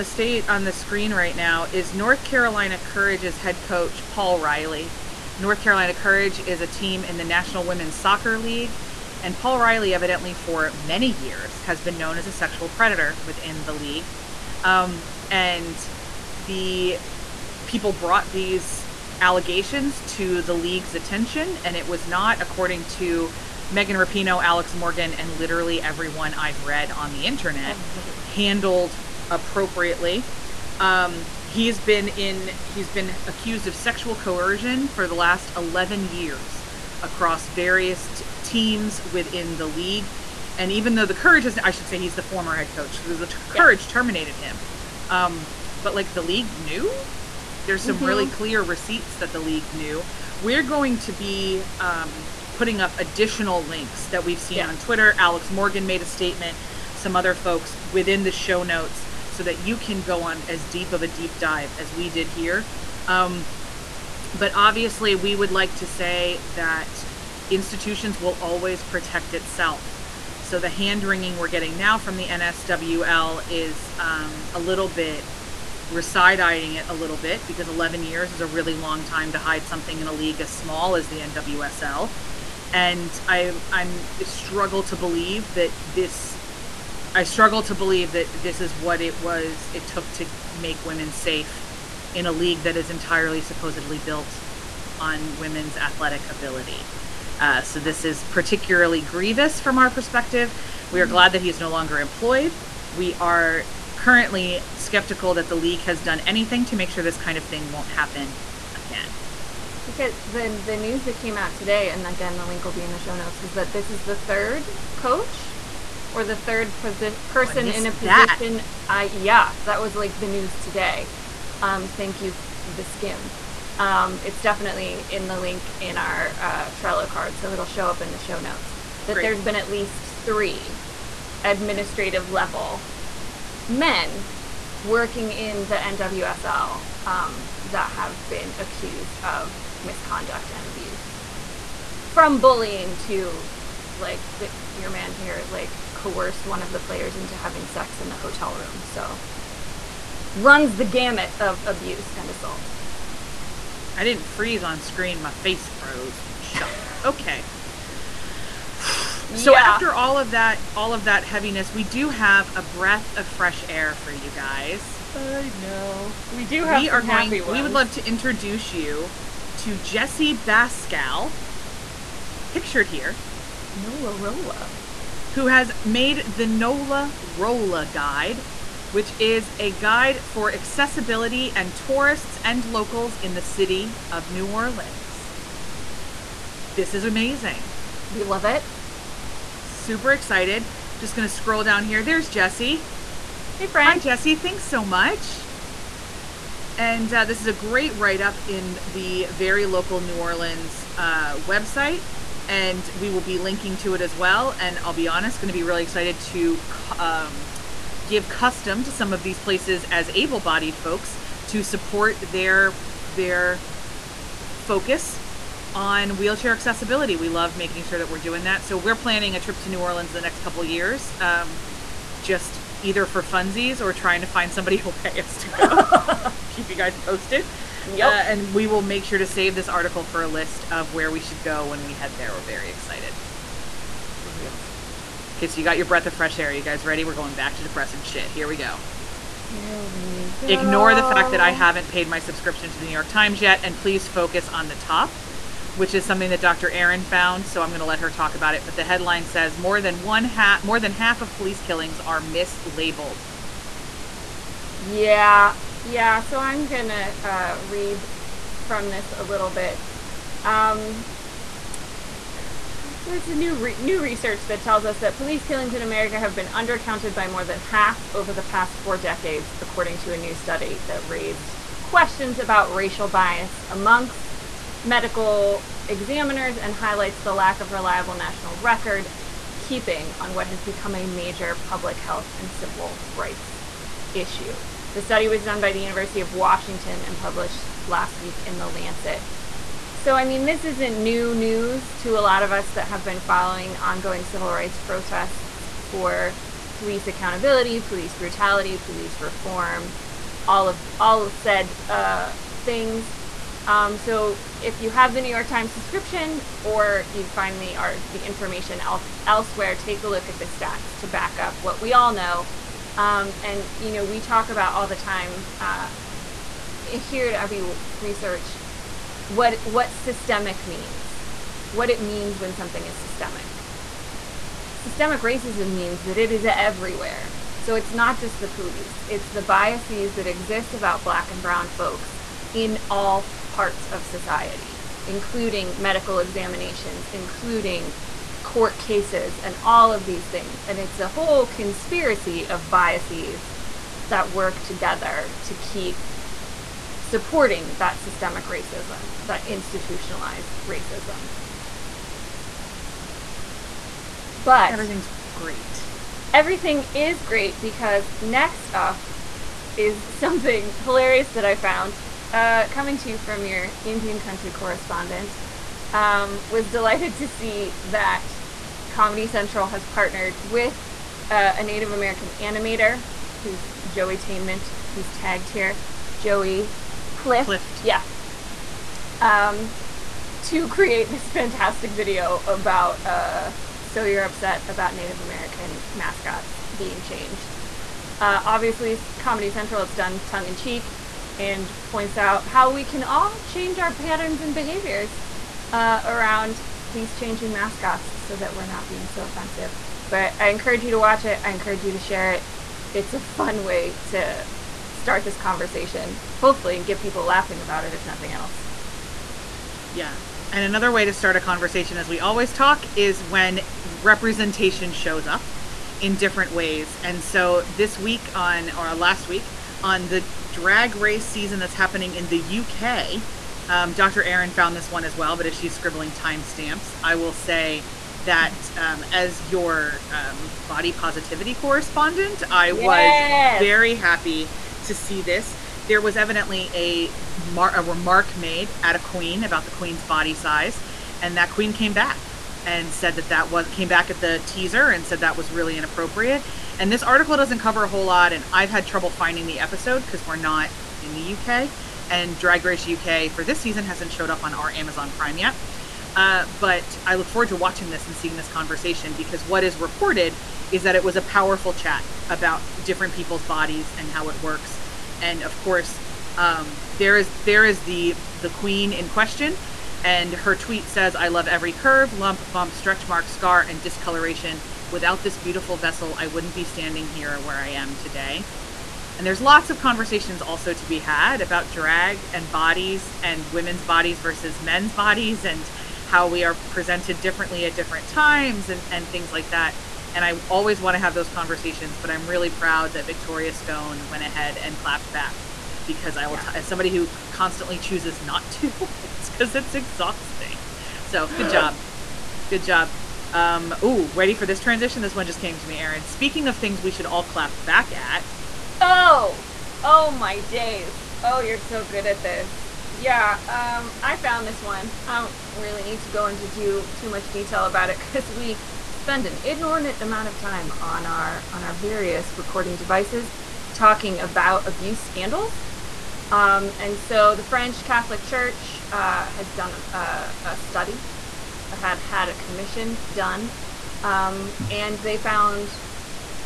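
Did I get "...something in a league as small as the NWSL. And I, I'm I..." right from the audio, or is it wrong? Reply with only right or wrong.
right.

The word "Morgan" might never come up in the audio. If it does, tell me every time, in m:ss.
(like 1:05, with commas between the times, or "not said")
0:24, 0:55.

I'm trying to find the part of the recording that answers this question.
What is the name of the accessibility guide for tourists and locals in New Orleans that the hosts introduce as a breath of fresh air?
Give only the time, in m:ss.
2:56.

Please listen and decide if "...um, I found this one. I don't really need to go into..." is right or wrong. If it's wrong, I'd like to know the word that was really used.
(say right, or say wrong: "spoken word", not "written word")
right.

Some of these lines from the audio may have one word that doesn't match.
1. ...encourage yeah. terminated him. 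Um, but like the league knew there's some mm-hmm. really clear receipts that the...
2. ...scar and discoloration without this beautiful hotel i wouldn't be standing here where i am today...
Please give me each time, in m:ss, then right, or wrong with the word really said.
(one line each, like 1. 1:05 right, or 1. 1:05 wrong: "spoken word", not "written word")
1. 0:43 wrong: "courage", not "encourage"
2. 7:53 wrong: "vessel", not "hotel".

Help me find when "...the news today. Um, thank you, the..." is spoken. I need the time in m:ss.
2:00.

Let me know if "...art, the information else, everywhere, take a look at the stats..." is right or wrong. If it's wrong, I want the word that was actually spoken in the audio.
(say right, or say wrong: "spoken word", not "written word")
wrong: "elsewhere", not "everywhere".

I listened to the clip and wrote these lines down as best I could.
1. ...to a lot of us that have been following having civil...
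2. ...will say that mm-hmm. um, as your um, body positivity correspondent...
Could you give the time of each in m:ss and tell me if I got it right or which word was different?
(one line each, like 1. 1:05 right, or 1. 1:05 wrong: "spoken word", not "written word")
1. 4:51 wrong: "ongoing", not "having"
2. 7:07 right.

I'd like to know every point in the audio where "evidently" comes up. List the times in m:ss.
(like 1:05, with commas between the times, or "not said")
0:09, 7:16.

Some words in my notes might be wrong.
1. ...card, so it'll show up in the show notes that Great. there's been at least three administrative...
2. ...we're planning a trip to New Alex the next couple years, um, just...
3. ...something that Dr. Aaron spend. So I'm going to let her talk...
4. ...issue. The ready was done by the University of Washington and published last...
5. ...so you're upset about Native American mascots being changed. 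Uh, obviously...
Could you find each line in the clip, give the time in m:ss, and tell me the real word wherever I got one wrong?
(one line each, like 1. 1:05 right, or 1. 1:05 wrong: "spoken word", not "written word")
1. 2:07 right
2. 3:38 wrong: "Orleans", not "Alex"
3. 4:06 wrong: "found", not "spend"
4. 4:44 wrong: "study", not "ready"
5. 6:23 right.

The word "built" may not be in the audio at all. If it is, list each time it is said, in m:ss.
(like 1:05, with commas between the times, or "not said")
1:34.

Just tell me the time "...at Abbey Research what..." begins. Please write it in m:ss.
5:17.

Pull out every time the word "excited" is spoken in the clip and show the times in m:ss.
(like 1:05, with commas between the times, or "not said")
3:10, 3:25, 3:52.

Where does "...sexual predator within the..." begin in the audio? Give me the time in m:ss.
0:12.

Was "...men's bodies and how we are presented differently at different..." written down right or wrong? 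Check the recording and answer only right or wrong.
right.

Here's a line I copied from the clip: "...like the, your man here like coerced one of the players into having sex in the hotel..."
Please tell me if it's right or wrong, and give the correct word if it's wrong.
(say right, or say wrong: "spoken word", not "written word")
right.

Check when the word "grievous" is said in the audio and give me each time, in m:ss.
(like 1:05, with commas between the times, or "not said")
1:39.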